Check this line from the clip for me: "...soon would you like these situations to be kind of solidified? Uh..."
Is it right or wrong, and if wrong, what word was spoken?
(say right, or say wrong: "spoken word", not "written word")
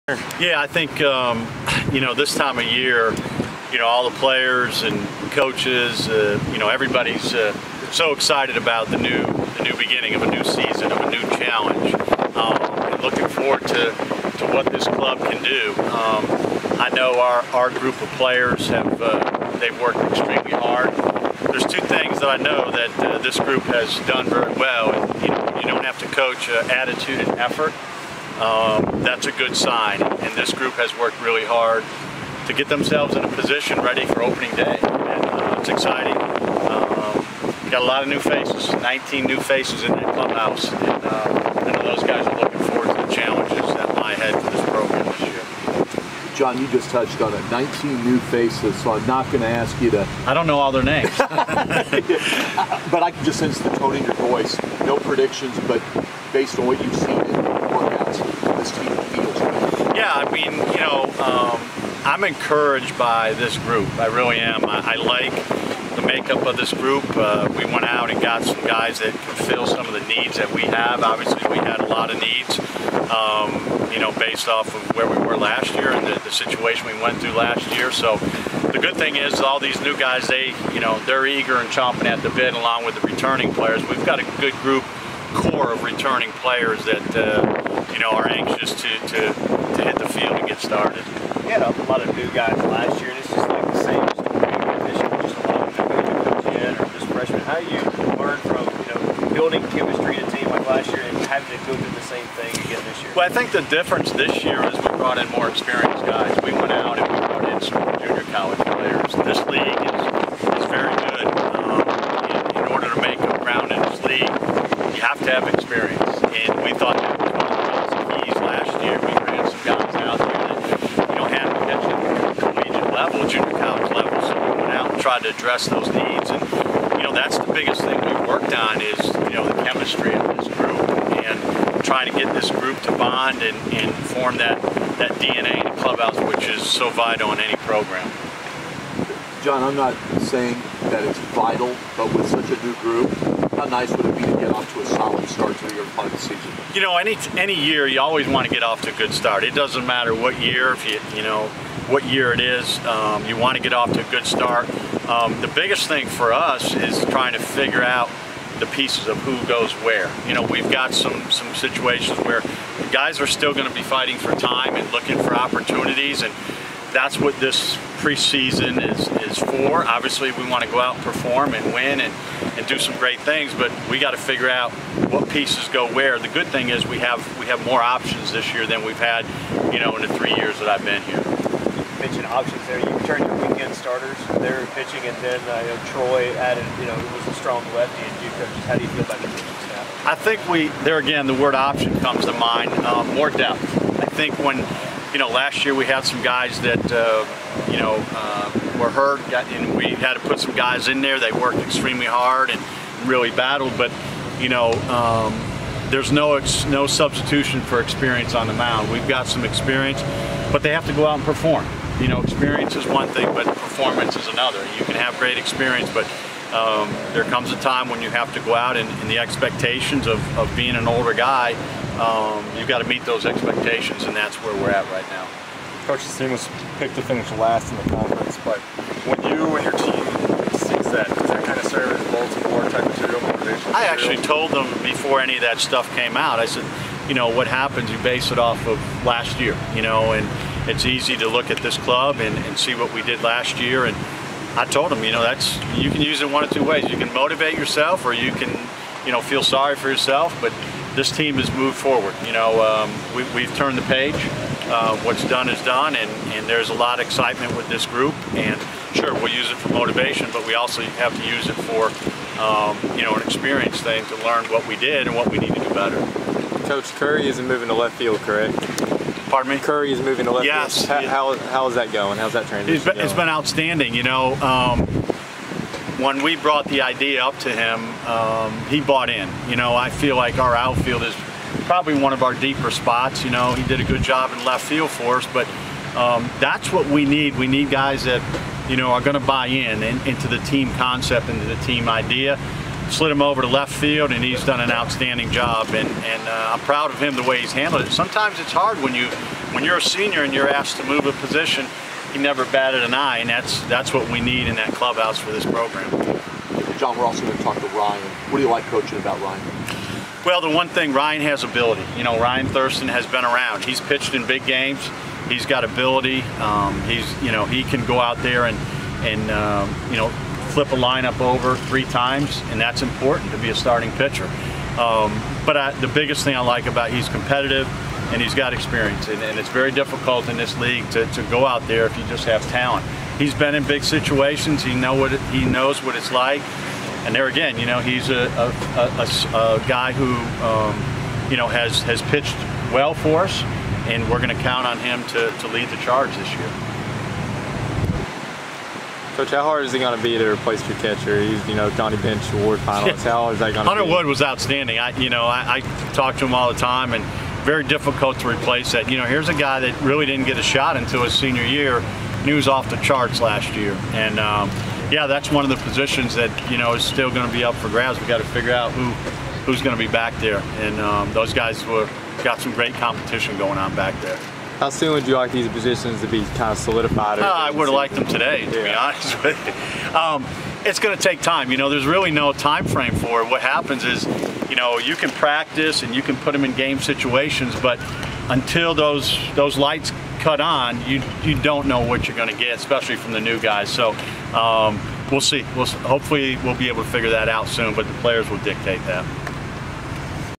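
wrong: "positions", not "situations".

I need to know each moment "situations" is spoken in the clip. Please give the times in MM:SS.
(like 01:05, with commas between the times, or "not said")
01:16, 02:41, 05:33, 06:26.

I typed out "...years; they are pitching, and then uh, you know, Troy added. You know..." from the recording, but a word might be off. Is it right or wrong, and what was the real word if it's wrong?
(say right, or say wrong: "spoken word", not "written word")
wrong: "starters", not "years".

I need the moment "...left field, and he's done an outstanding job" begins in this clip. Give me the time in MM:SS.
04:53.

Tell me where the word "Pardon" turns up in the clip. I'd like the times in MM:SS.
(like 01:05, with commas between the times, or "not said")
04:29.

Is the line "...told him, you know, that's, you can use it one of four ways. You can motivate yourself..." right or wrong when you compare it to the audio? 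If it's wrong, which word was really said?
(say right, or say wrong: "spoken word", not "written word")
wrong: "two", not "four".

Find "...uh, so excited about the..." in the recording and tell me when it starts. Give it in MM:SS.
00:07.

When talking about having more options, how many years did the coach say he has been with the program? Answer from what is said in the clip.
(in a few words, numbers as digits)
3.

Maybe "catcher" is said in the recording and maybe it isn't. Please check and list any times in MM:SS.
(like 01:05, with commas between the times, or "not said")
05:50.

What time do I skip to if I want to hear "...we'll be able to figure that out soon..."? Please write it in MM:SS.
06:36.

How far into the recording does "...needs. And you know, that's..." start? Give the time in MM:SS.
02:05.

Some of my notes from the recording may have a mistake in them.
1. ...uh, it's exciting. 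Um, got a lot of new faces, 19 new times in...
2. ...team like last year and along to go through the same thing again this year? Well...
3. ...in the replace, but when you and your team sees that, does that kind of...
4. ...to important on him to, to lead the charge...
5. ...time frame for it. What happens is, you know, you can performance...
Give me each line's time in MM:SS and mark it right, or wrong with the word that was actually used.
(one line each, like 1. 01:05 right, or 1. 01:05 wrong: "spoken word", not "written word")
1. 00:35 wrong: "faces", not "times"
2. 01:40 wrong: "having", not "along"
3. 03:47 wrong: "conference", not "replace"
4. 05:44 wrong: "count", not "important"
5. 06:22 wrong: "practice", not "performance".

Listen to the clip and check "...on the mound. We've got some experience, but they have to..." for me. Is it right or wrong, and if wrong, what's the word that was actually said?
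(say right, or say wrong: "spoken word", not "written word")
right.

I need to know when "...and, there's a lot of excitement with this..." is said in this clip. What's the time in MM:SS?
04:16.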